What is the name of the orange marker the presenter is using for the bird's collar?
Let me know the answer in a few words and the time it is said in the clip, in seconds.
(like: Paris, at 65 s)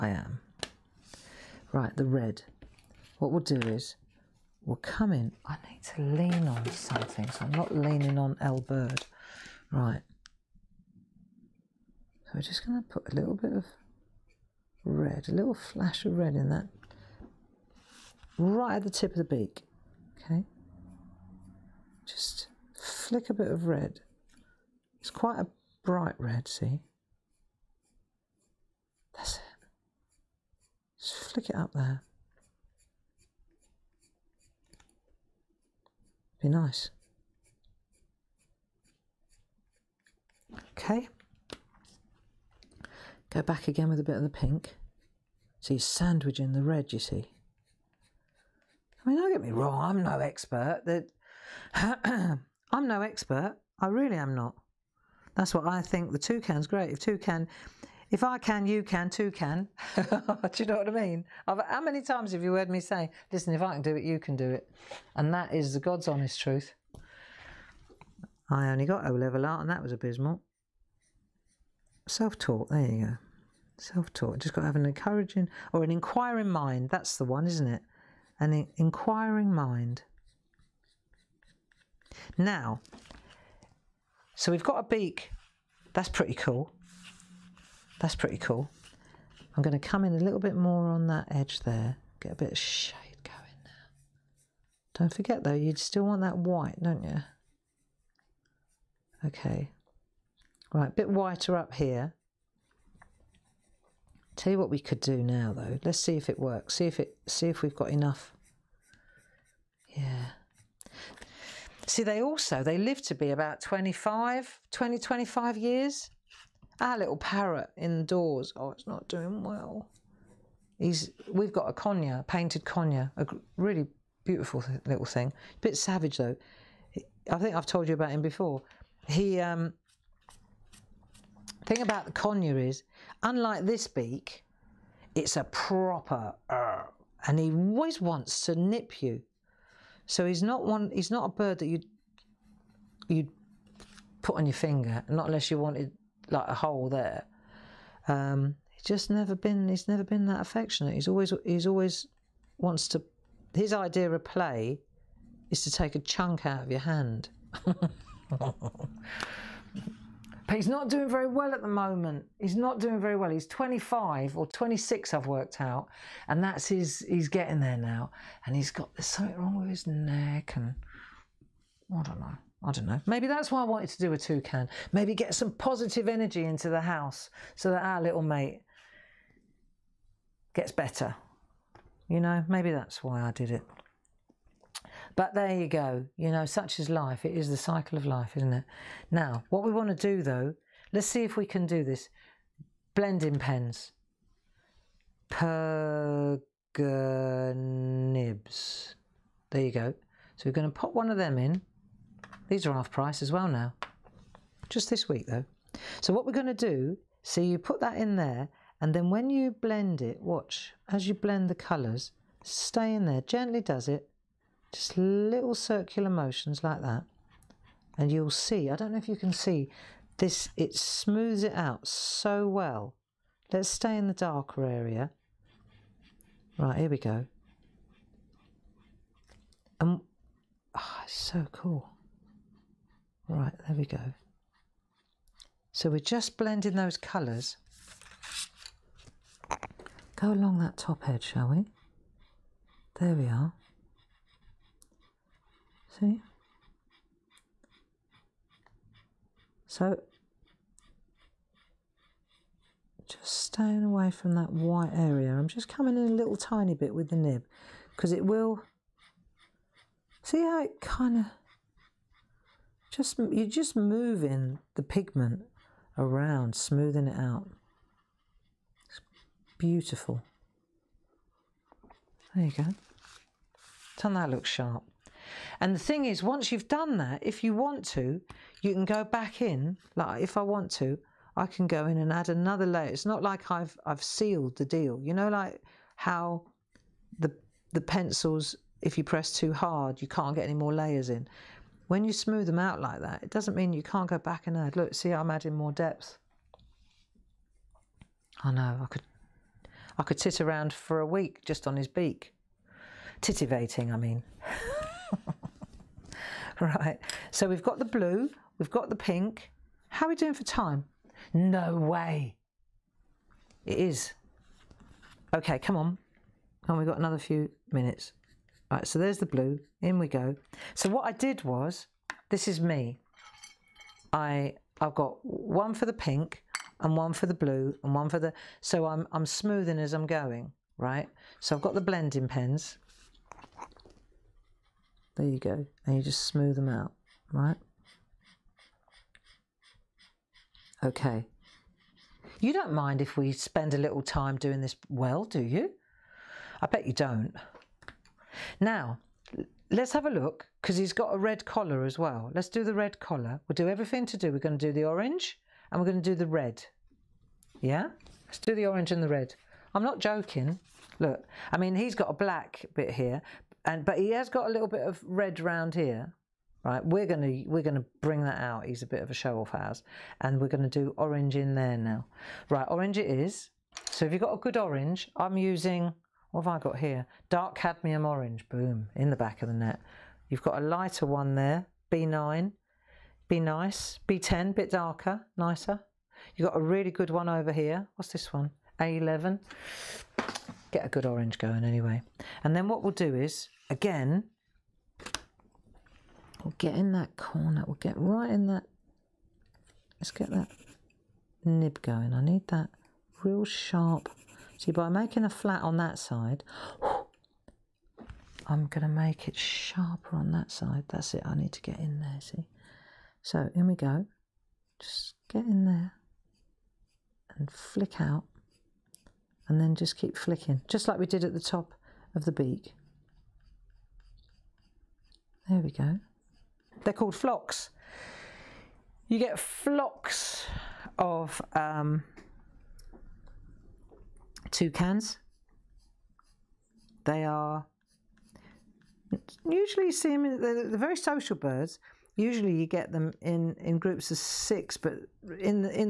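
Dark cadmium orange, at 377 s.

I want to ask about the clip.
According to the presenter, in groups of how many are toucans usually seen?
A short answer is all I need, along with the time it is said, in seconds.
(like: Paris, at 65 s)
6, at 444 s.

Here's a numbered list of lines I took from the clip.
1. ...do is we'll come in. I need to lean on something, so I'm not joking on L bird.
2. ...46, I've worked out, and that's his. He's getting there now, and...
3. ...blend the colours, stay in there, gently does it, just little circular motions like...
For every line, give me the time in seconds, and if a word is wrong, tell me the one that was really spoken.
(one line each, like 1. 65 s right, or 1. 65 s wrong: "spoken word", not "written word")
1. 3 s wrong: "leaning", not "joking"
2. 164 s wrong: "26", not "46"
3. 211 s right.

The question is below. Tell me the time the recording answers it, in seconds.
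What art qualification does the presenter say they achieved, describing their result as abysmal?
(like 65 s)
69 s.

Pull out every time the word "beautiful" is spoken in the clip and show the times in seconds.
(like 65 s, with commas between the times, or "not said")
124 s, 269 s.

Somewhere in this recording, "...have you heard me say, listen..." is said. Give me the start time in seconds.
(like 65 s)
62 s.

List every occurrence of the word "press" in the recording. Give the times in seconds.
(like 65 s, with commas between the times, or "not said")
289 s.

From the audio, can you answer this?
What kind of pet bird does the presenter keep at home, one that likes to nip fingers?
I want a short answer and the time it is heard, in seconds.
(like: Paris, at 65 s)
Painted conure, at 122 s.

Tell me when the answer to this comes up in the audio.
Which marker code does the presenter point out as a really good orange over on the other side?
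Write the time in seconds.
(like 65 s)
388 s.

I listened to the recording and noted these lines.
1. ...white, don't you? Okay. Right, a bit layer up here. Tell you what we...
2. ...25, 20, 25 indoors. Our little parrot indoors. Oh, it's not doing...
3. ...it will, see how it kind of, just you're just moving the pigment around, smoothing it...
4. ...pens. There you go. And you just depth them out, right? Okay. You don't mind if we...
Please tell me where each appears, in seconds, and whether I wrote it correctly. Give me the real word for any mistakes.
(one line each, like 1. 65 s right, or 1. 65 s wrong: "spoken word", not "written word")
1. 96 s wrong: "whiter", not "layer"
2. 113 s wrong: "years", not "indoors"
3. 258 s right
4. 332 s wrong: "smooth", not "depth".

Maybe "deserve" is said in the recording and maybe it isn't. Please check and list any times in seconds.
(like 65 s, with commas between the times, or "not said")
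not said.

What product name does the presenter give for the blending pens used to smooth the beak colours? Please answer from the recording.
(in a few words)
Pergnibs.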